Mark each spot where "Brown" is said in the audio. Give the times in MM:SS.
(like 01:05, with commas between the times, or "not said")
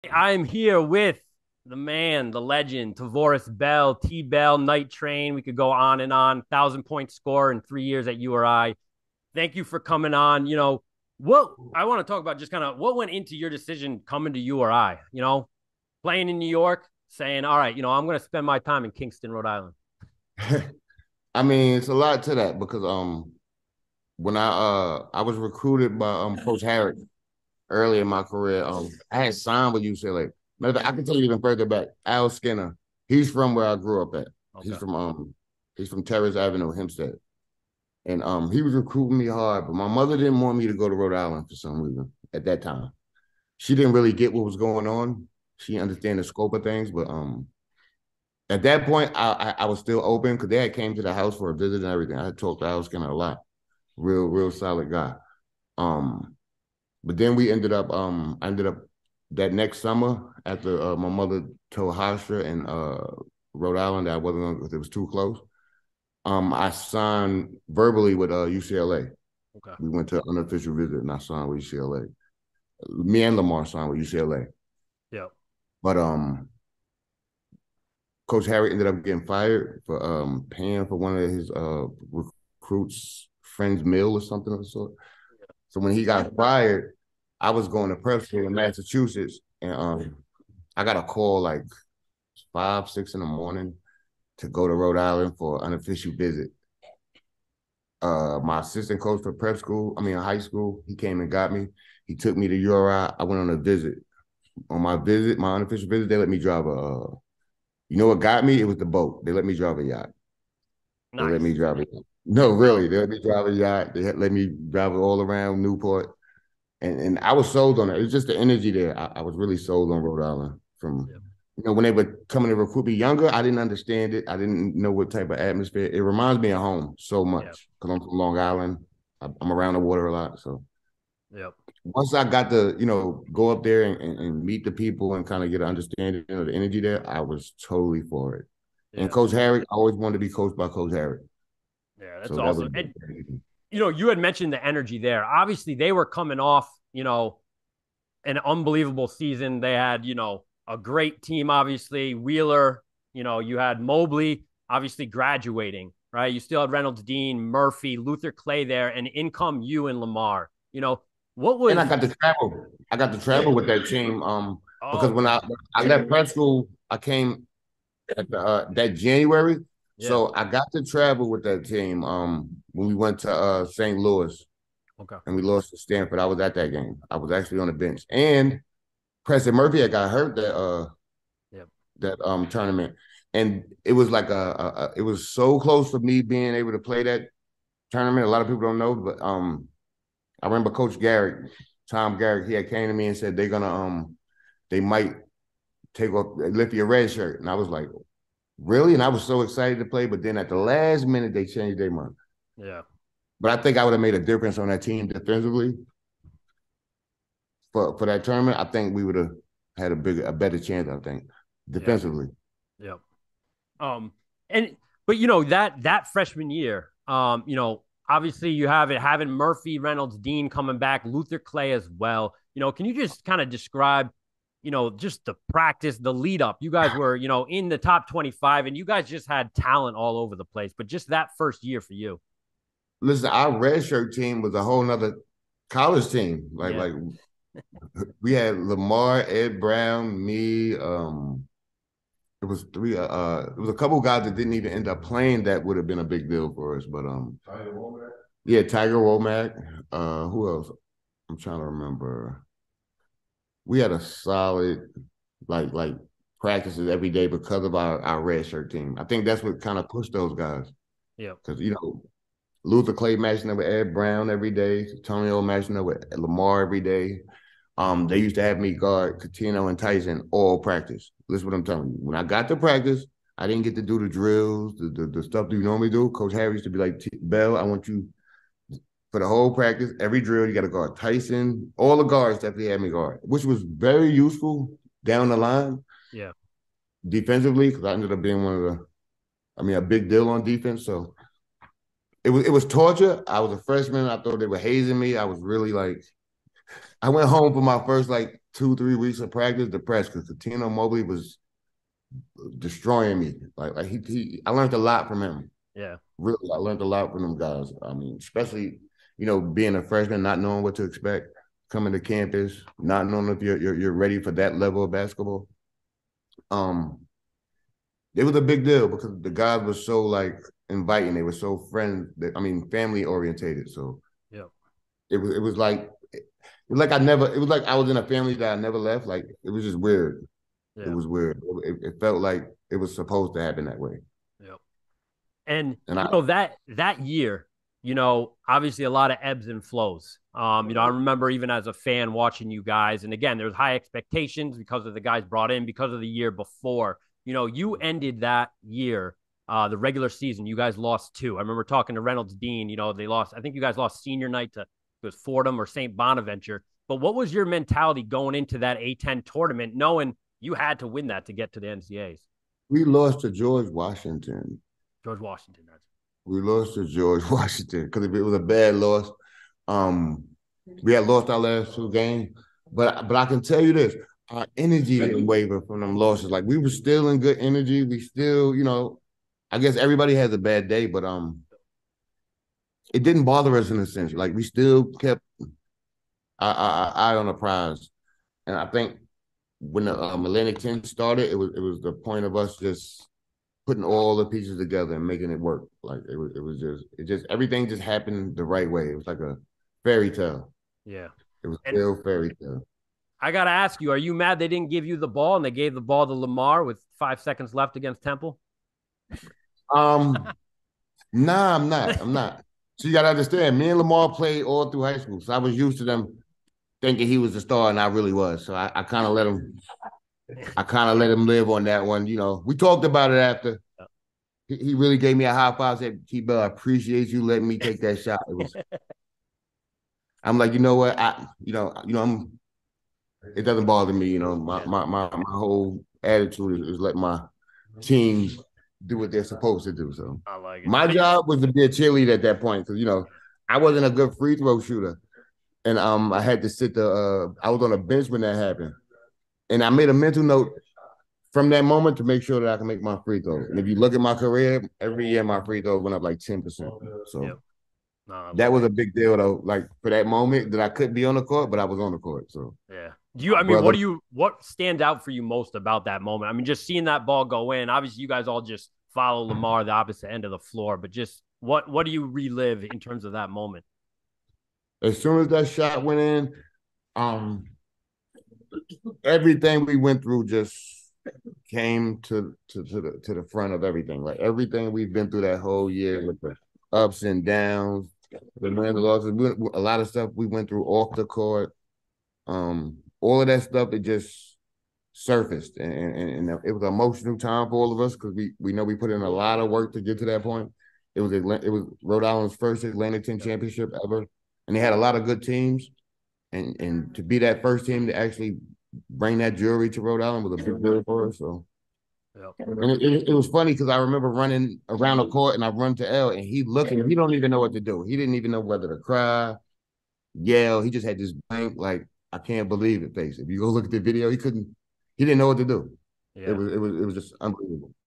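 03:59, 04:23.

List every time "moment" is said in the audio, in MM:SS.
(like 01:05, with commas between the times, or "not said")
07:31, 07:40, 07:46, 07:53.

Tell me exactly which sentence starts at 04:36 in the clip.
Coach Harrick used to be like, Bell, I want you for the whole practice.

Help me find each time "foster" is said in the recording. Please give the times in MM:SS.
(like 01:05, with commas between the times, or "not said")
not said.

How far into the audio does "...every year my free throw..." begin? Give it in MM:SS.
07:34.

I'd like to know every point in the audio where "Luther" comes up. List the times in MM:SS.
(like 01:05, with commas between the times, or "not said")
02:37, 03:41, 04:22.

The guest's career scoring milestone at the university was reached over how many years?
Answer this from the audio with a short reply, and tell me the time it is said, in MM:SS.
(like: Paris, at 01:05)
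3, at 00:07.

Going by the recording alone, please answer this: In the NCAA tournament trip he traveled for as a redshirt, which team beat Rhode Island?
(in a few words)
Stanford.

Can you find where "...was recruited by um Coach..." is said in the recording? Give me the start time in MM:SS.
00:25.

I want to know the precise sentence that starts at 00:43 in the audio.
She didn't really get what was going on.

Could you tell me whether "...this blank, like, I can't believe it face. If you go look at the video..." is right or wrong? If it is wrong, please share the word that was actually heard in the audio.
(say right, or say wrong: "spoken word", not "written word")
right.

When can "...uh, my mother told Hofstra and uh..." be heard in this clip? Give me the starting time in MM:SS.
01:00.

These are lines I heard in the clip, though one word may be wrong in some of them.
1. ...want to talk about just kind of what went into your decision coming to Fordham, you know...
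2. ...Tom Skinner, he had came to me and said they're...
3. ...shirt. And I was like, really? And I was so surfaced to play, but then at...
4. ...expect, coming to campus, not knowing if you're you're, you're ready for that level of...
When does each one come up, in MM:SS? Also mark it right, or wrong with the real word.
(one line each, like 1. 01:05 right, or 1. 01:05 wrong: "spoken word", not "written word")
1. 00:11 wrong: "URI", not "Fordham"
2. 03:11 wrong: "Garrick", not "Skinner"
3. 03:17 wrong: "excited", not "surfaced"
4. 05:10 right.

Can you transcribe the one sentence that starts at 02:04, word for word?
I didn't know what type of atmosphere.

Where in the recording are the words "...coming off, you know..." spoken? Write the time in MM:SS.
02:26.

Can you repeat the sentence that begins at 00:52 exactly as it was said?
I had talked to Al Skinner a lot, real real solid guy.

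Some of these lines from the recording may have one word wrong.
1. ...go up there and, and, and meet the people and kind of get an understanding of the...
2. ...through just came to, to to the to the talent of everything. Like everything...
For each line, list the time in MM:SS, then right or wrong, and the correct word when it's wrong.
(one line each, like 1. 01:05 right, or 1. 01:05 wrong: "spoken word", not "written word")
1. 02:13 right
2. 08:00 wrong: "front", not "talent".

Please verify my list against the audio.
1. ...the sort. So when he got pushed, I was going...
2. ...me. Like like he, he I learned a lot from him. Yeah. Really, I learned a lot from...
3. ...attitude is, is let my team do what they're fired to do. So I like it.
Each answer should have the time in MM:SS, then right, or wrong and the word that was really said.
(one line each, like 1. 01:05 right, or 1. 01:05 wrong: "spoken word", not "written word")
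1. 01:24 wrong: "fired", not "pushed"
2. 05:03 right
3. 07:16 wrong: "supposed", not "fired".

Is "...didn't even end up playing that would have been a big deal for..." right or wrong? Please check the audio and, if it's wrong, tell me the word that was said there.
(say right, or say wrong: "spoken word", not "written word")
right.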